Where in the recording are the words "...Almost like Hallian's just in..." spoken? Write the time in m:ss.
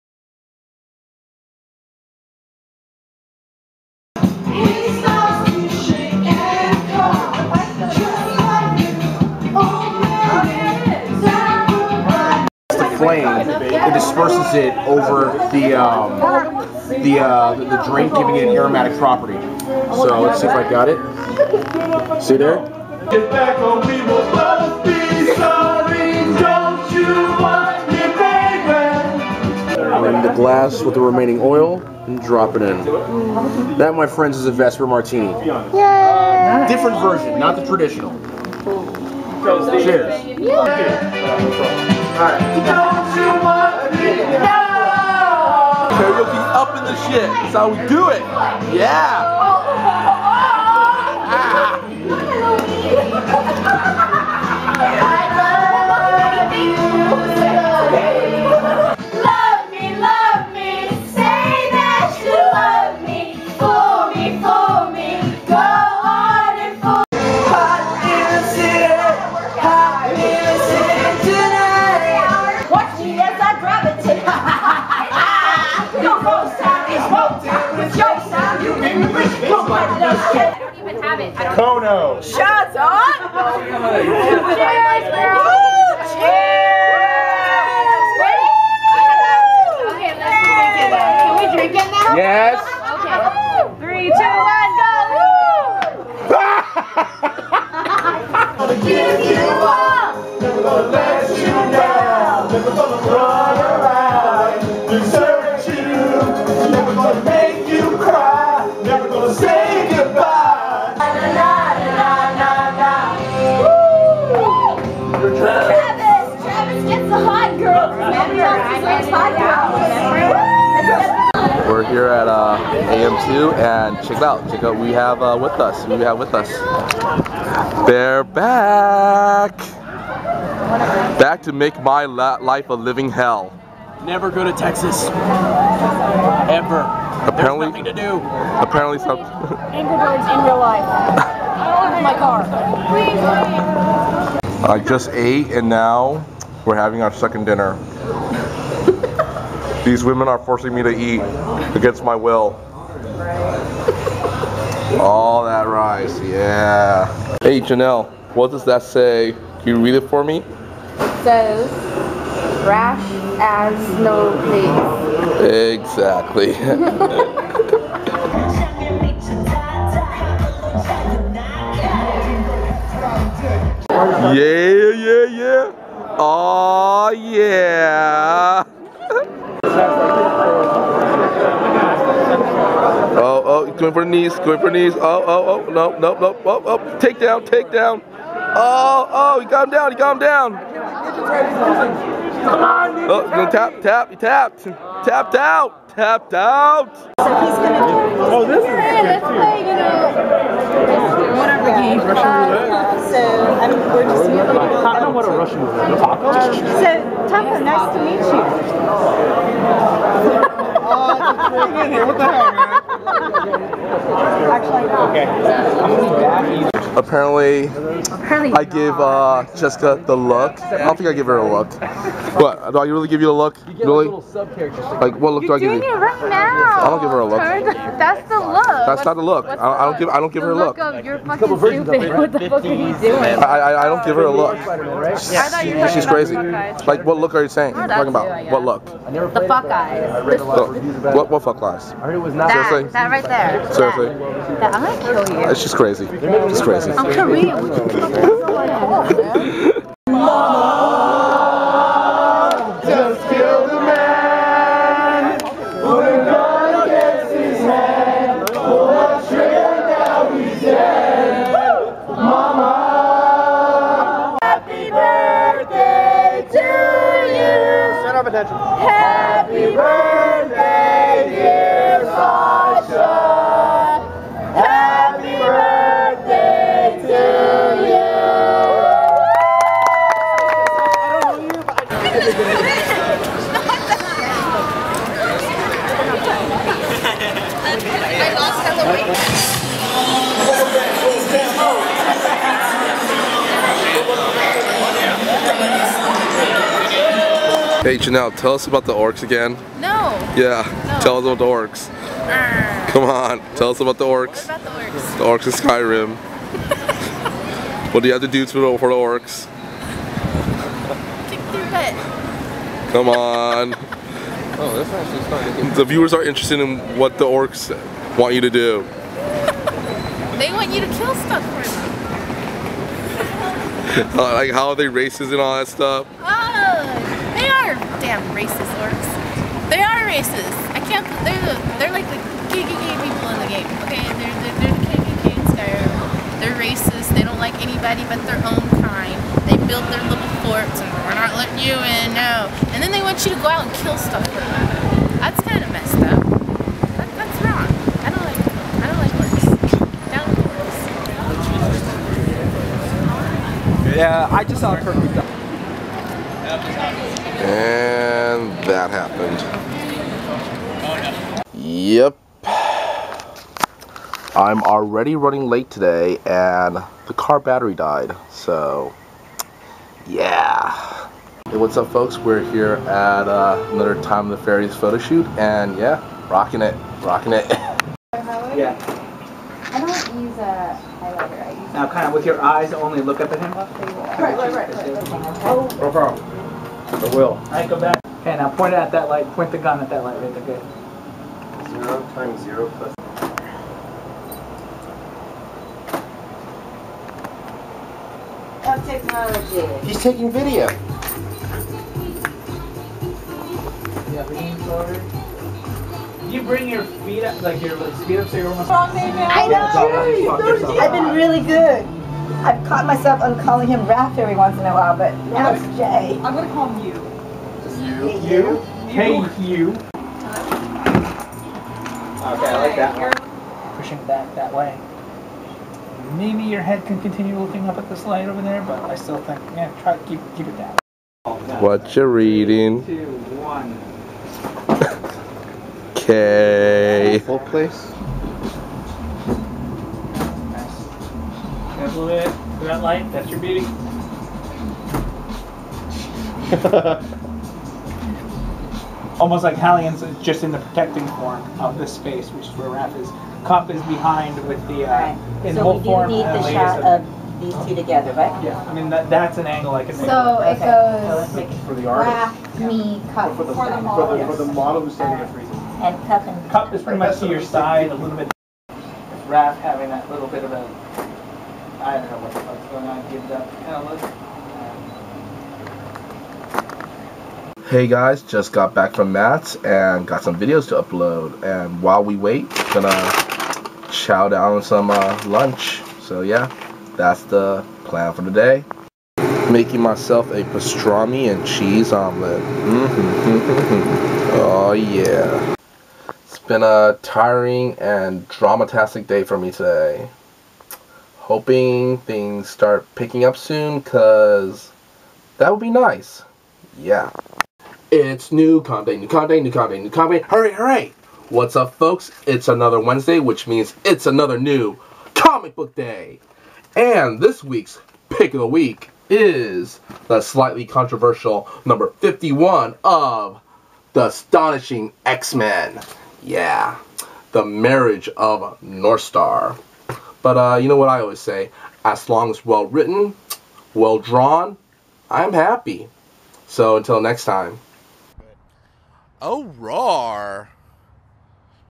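7:29.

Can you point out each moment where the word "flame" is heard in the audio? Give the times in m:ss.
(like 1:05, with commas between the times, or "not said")
0:13.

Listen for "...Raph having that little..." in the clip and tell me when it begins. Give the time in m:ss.
7:49.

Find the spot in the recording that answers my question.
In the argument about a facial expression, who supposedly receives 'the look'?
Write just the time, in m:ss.
3:39.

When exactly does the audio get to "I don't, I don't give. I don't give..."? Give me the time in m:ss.
3:49.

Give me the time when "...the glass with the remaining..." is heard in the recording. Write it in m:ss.
0:30.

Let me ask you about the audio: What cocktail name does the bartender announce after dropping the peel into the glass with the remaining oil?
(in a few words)
Vesper Martini.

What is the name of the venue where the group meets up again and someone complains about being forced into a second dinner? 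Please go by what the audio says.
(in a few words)
AM2.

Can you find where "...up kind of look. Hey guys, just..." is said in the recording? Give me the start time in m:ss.
7:53.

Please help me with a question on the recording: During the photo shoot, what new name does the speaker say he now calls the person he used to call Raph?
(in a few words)
Jay.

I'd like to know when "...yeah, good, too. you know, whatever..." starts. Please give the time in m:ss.
3:18.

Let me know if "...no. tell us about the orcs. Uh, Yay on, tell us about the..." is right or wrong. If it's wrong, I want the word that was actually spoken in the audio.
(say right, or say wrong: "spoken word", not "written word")
wrong: "Come", not "Yay".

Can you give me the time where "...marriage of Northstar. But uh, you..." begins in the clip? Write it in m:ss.
8:47.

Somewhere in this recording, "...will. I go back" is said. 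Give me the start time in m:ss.
6:27.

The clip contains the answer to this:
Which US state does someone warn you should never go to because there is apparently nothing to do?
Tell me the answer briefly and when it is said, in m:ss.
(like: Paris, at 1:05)
Texas, at 2:14.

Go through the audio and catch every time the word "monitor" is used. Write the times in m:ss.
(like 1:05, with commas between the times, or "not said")
not said.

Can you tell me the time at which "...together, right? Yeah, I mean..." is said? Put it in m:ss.
7:37.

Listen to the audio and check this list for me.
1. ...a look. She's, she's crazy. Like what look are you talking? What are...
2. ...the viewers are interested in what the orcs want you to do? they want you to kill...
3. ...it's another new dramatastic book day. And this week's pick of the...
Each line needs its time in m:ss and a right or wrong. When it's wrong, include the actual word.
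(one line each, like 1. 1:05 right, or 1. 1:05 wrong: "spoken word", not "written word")
1. 3:54 wrong: "saying", not "talking"
2. 5:15 right
3. 8:33 wrong: "comic", not "dramatastic".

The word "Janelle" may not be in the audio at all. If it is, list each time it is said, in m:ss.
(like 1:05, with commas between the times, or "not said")
2:37, 4:57.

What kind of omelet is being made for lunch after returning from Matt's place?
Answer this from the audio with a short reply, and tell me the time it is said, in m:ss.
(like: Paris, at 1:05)
pastrami and cheese, at 8:10.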